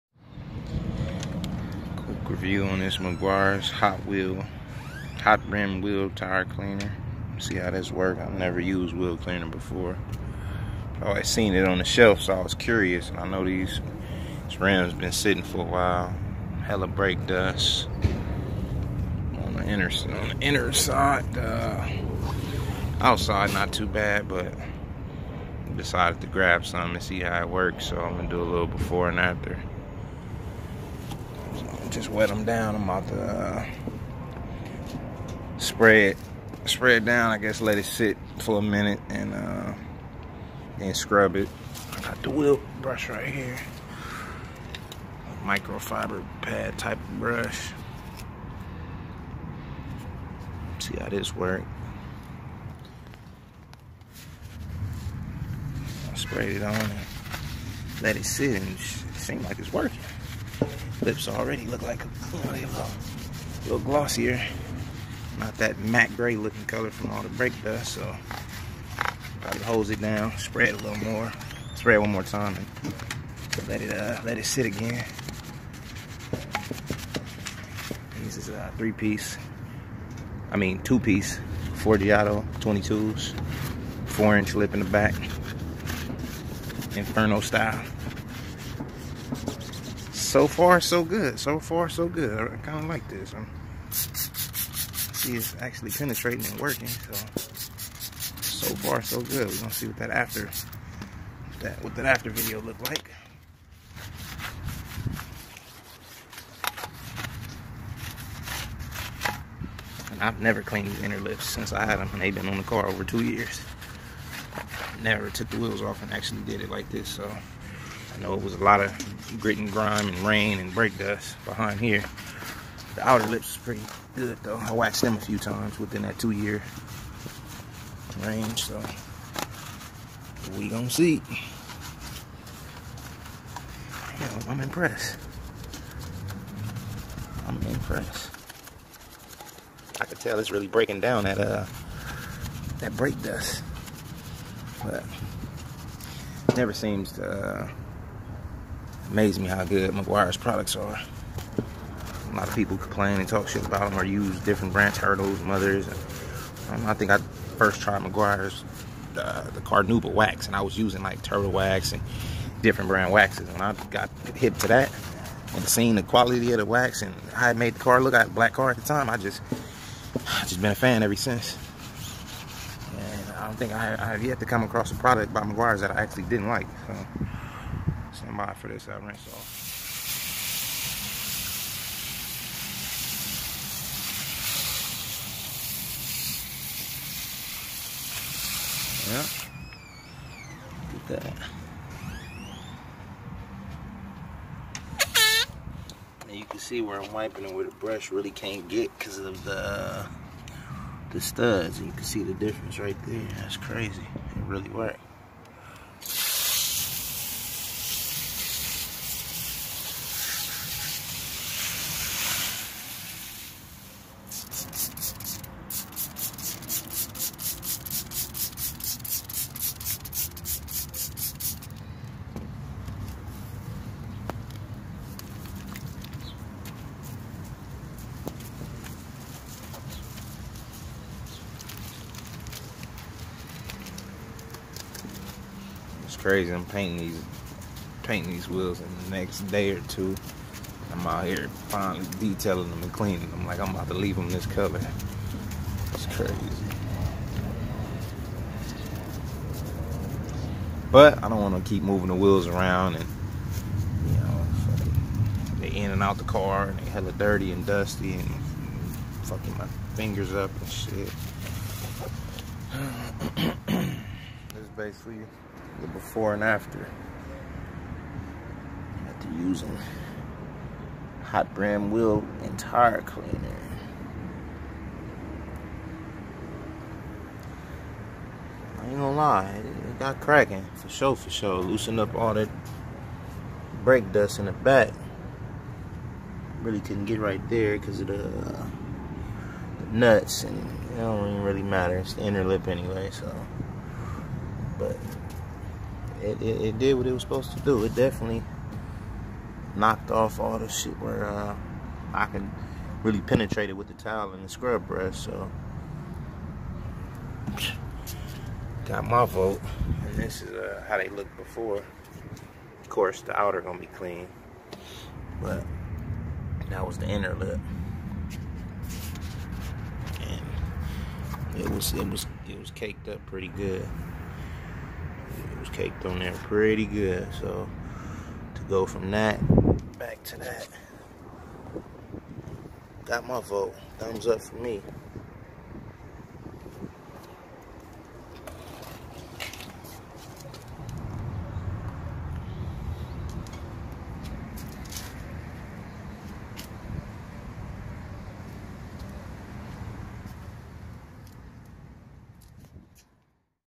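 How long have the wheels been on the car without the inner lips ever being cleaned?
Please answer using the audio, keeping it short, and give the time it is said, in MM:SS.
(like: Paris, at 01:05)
over 2 years, at 01:52.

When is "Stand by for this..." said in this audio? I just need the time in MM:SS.
02:58.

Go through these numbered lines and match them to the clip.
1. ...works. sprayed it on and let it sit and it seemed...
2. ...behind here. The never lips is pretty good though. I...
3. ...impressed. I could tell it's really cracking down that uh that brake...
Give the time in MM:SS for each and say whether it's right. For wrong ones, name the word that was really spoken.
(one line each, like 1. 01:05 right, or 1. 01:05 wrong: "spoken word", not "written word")
1. 00:51 right
2. 02:01 wrong: "outer", not "never"
3. 02:17 wrong: "breaking", not "cracking".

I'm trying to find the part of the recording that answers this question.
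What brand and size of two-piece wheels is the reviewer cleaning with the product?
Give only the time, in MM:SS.
01:21.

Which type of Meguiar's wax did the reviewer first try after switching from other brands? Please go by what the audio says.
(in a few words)
Carnuba wax.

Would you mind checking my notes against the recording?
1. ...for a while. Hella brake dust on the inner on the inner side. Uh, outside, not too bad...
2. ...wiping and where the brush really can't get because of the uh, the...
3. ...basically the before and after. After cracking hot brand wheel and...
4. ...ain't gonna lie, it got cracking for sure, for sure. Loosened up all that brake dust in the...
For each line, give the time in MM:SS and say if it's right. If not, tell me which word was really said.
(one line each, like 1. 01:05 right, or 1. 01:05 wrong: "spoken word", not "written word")
1. 00:15 right
2. 03:17 right
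3. 04:24 wrong: "using", not "cracking"
4. 04:38 right.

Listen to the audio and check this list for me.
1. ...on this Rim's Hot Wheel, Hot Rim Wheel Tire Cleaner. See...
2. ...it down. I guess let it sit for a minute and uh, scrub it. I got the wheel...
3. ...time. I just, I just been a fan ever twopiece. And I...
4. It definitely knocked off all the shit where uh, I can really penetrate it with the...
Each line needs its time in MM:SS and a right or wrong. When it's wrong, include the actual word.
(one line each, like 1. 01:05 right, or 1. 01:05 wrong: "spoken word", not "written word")
1. 00:02 wrong: "Meguiar", not "Rim"
2. 00:36 right
3. 02:48 wrong: "since", not "twopiece"
4. 04:57 right.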